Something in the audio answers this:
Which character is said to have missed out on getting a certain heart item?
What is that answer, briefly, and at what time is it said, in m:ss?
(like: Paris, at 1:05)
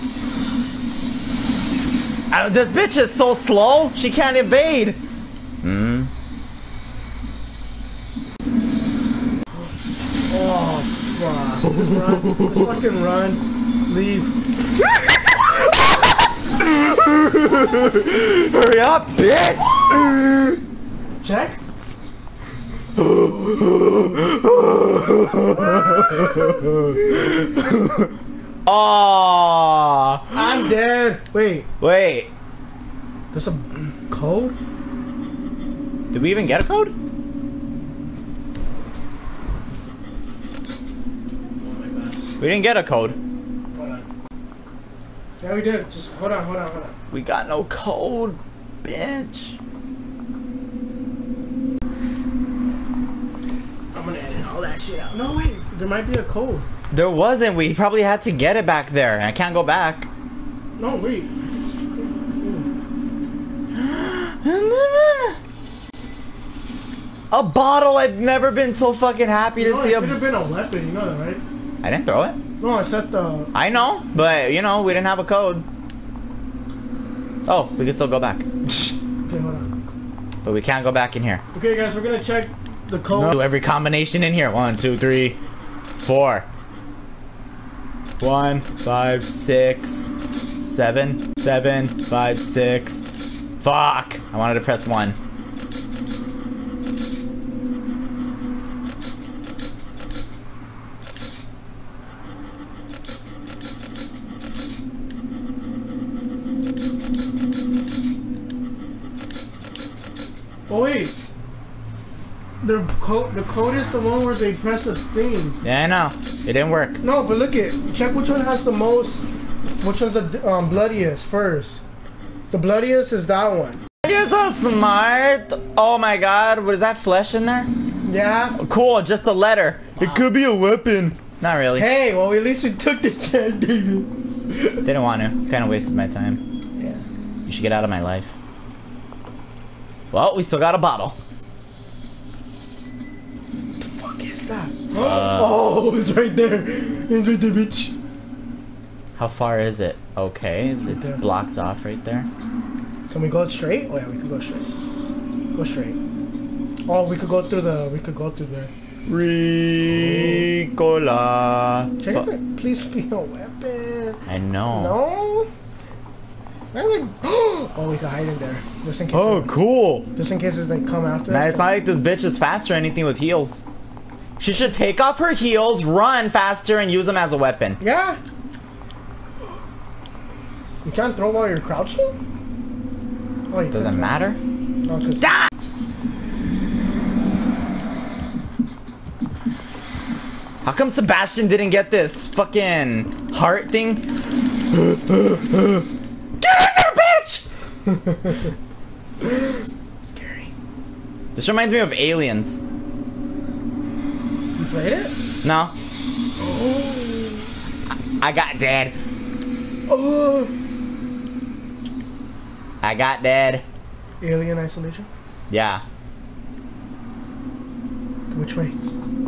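Sebastian, at 3:10.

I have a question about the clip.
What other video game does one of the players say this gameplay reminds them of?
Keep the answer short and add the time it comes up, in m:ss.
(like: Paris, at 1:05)
Alien Isolation, at 3:34.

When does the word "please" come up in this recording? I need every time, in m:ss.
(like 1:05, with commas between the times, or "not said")
2:42.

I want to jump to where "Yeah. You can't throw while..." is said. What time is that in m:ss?
2:57.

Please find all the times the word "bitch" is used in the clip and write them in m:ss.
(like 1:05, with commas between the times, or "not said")
0:02, 0:19, 0:48, 2:27, 2:51, 3:17.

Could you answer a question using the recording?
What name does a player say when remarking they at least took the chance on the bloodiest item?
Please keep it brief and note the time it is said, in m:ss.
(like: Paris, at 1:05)
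David, at 2:13.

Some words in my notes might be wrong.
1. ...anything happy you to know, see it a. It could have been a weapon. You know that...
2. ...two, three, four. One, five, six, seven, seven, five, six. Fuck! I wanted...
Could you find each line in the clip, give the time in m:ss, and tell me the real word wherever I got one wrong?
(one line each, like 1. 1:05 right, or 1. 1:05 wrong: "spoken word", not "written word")
1. 1:08 wrong: "fucking", not "anything"
2. 1:24 right.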